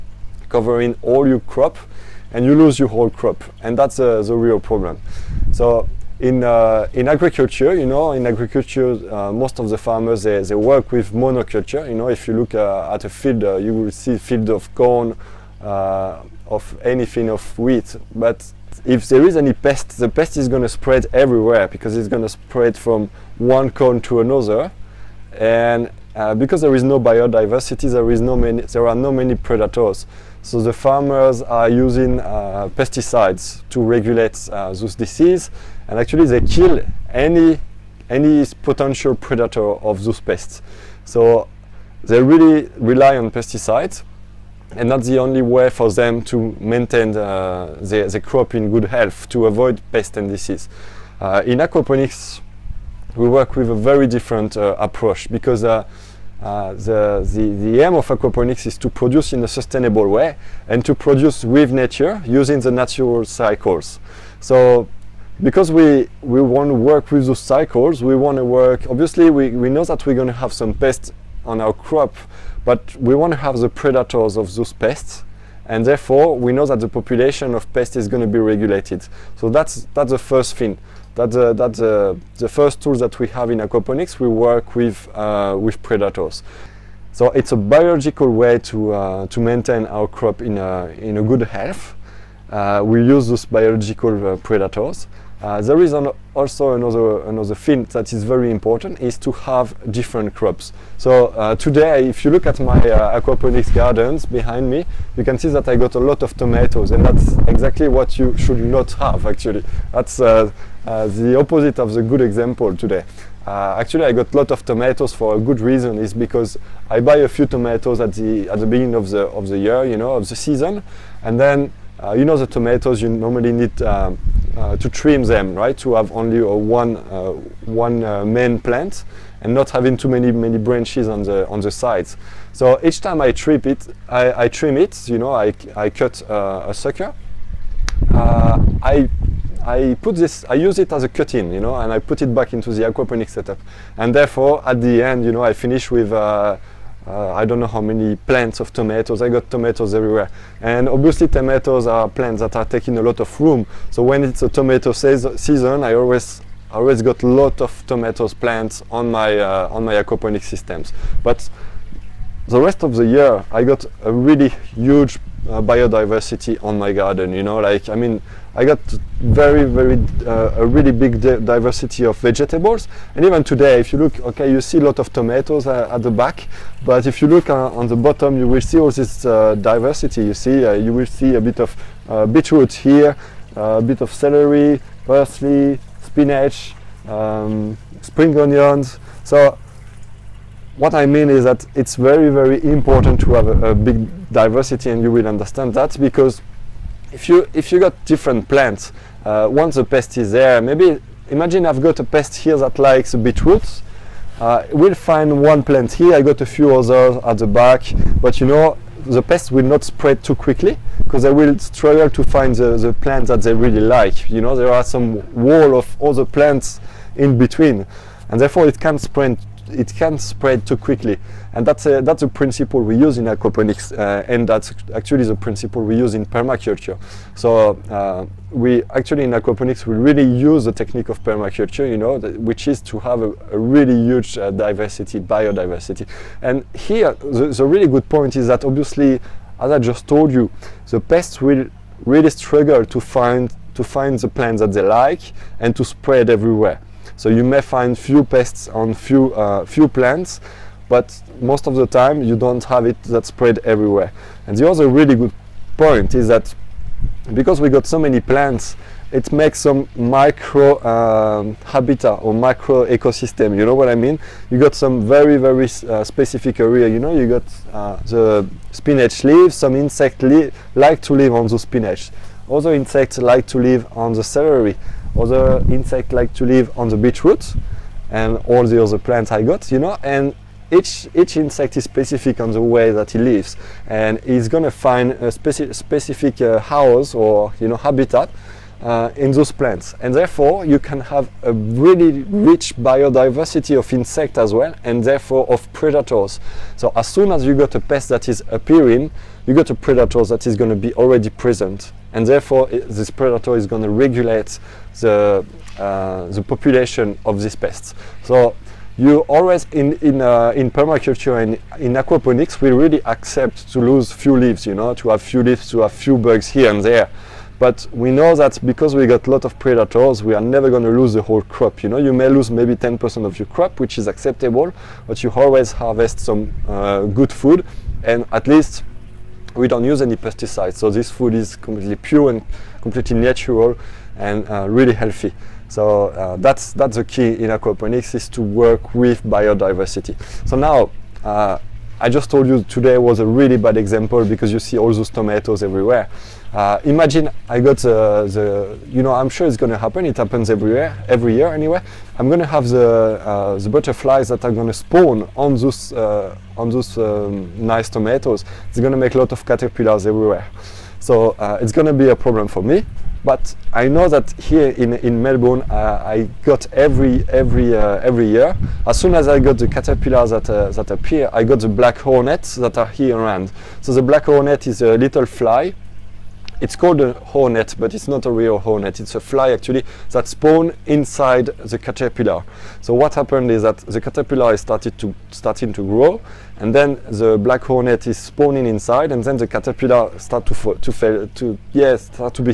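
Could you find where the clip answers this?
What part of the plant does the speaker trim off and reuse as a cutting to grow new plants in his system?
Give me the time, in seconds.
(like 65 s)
136 s.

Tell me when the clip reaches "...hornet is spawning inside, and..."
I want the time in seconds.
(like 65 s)
387 s.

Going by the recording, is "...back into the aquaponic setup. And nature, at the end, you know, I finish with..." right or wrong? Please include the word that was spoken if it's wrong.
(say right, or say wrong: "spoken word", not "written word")
wrong: "therefore", not "nature".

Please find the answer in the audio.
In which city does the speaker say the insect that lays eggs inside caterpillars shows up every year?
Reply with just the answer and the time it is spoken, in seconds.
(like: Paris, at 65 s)
Melbourne, at 365 s.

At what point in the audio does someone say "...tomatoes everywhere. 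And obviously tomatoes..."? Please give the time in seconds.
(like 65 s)
149 s.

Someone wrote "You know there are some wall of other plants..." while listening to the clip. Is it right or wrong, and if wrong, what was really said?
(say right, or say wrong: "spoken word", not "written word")
right.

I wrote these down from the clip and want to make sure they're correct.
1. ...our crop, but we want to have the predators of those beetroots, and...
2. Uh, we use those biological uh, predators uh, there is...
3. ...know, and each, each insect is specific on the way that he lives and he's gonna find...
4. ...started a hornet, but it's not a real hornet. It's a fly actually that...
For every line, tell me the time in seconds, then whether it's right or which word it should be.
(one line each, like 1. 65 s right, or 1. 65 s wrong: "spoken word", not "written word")
1. 71 s wrong: "pests", not "beetroots"
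2. 92 s right
3. 279 s right
4. 376 s wrong: "called", not "started".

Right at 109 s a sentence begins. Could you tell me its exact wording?
That's uh, uh, the opposite of the good example today.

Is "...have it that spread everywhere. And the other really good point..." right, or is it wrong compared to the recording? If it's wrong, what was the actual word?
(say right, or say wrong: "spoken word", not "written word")
right.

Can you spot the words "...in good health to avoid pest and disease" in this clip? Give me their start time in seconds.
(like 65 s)
48 s.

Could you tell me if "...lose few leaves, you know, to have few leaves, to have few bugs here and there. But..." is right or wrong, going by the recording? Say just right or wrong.
right.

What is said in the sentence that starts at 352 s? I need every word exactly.
I'm going to have the uh, the butterflies that are going to spawn on those uh, on those um, nice tomatoes.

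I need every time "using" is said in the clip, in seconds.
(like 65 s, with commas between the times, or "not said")
31 s, 62 s.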